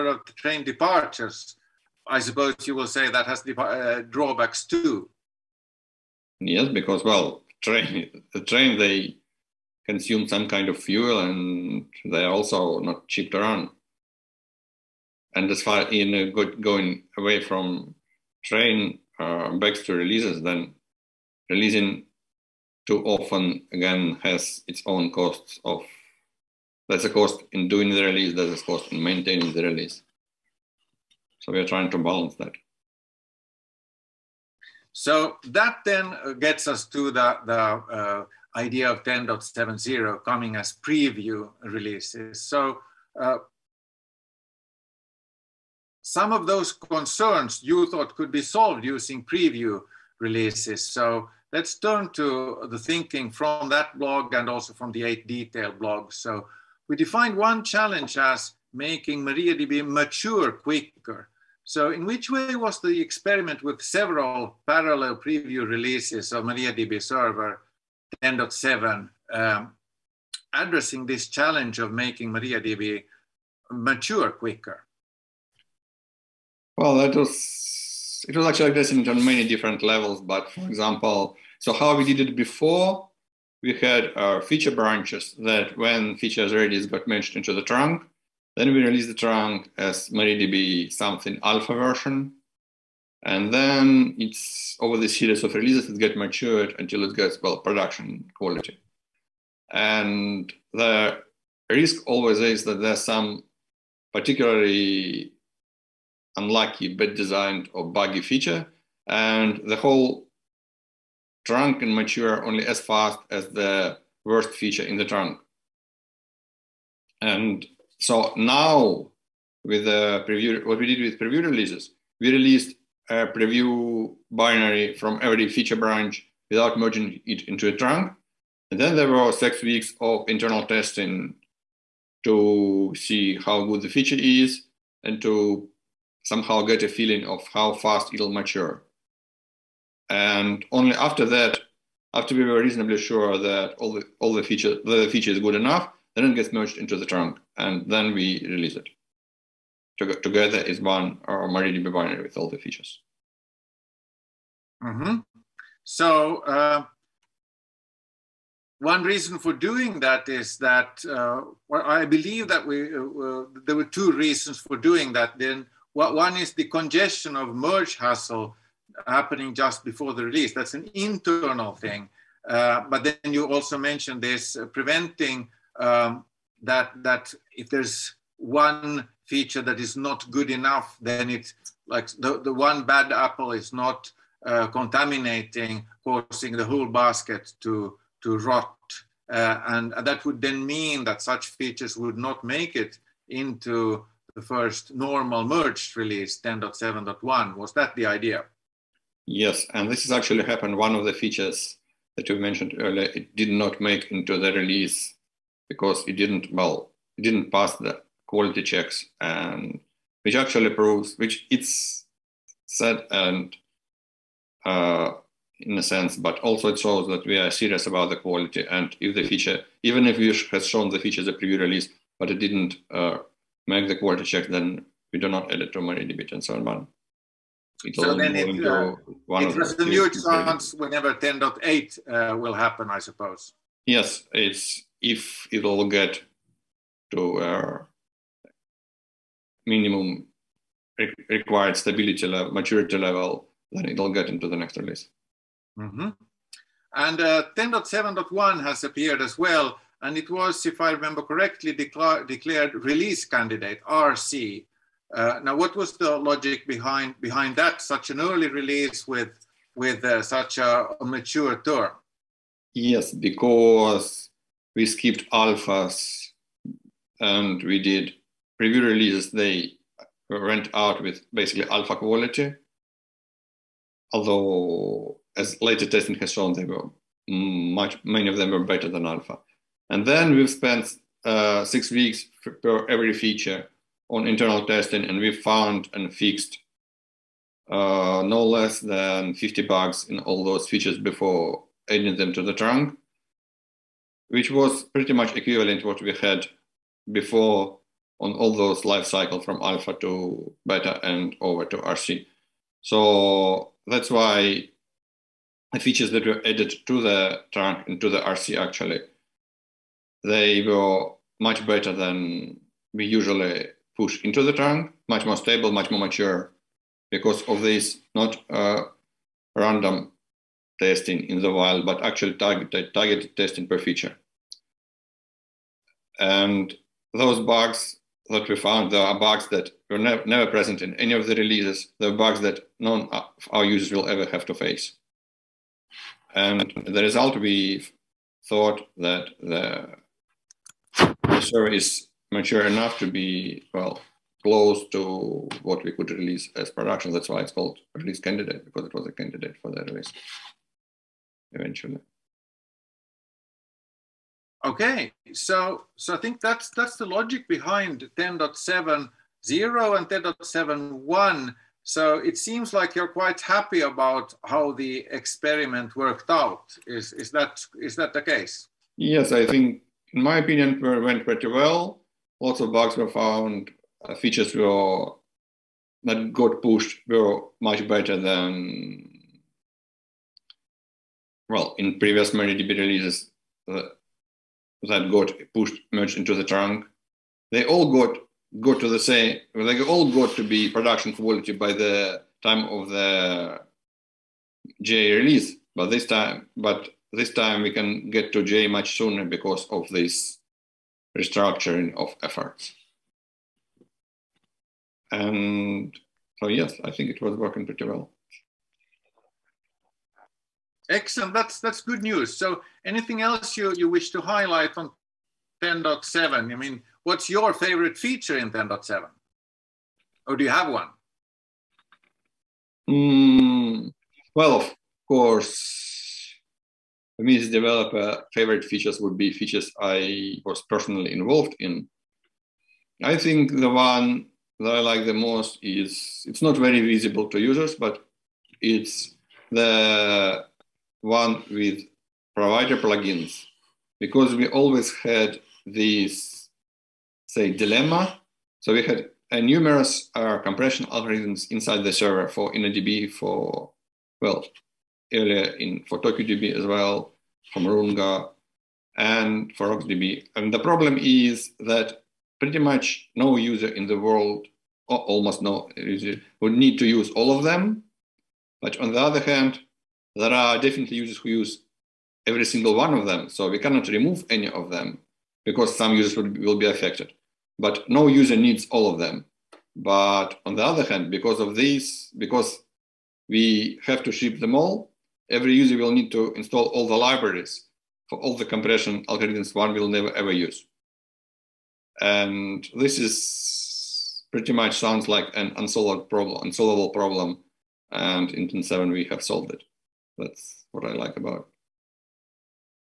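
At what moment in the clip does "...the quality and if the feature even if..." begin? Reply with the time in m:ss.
3:38.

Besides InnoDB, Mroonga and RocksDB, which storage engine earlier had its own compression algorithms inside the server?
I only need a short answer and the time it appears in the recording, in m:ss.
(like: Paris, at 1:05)
TokuDB, at 7:35.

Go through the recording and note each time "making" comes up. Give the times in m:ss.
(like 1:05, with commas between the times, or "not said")
0:58, 1:11.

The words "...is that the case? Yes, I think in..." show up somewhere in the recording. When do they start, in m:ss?
6:07.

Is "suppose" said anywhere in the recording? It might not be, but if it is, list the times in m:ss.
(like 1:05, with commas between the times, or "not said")
0:02, 3:52.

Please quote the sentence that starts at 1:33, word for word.
And then it's over the series of releases, it gets matured until it gets, well, production quality.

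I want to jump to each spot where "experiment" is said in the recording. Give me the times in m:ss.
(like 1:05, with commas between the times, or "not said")
1:02, 6:05.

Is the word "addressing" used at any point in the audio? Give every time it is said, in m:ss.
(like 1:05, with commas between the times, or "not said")
1:10, 1:18.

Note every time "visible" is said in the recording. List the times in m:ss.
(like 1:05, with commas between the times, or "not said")
7:16.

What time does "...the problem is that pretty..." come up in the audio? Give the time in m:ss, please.
7:40.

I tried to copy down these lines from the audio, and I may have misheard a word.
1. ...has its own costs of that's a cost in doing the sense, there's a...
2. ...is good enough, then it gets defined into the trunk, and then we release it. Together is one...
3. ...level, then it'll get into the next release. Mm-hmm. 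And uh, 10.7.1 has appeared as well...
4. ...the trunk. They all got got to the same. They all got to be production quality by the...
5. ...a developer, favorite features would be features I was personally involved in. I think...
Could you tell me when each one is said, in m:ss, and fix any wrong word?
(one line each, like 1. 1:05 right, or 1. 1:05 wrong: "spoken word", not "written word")
1. 0:24 wrong: "release", not "sense"
2. 2:25 wrong: "merged", not "defined"
3. 4:02 right
4. 6:26 right
5. 7:07 right.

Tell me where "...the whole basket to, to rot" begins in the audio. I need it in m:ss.
3:06.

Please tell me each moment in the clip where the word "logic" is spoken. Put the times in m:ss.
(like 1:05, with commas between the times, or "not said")
4:16, 5:57.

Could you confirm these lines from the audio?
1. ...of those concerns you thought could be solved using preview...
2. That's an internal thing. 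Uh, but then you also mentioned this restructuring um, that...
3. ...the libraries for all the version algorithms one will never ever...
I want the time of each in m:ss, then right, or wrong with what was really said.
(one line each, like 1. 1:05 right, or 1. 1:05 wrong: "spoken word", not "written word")
1. 0:46 right
2. 2:50 wrong: "preventing", not "restructuring"
3. 8:06 wrong: "compression", not "version".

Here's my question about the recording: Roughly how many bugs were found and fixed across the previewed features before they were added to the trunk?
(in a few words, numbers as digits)
50.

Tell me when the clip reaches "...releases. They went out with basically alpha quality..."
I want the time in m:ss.
4:28.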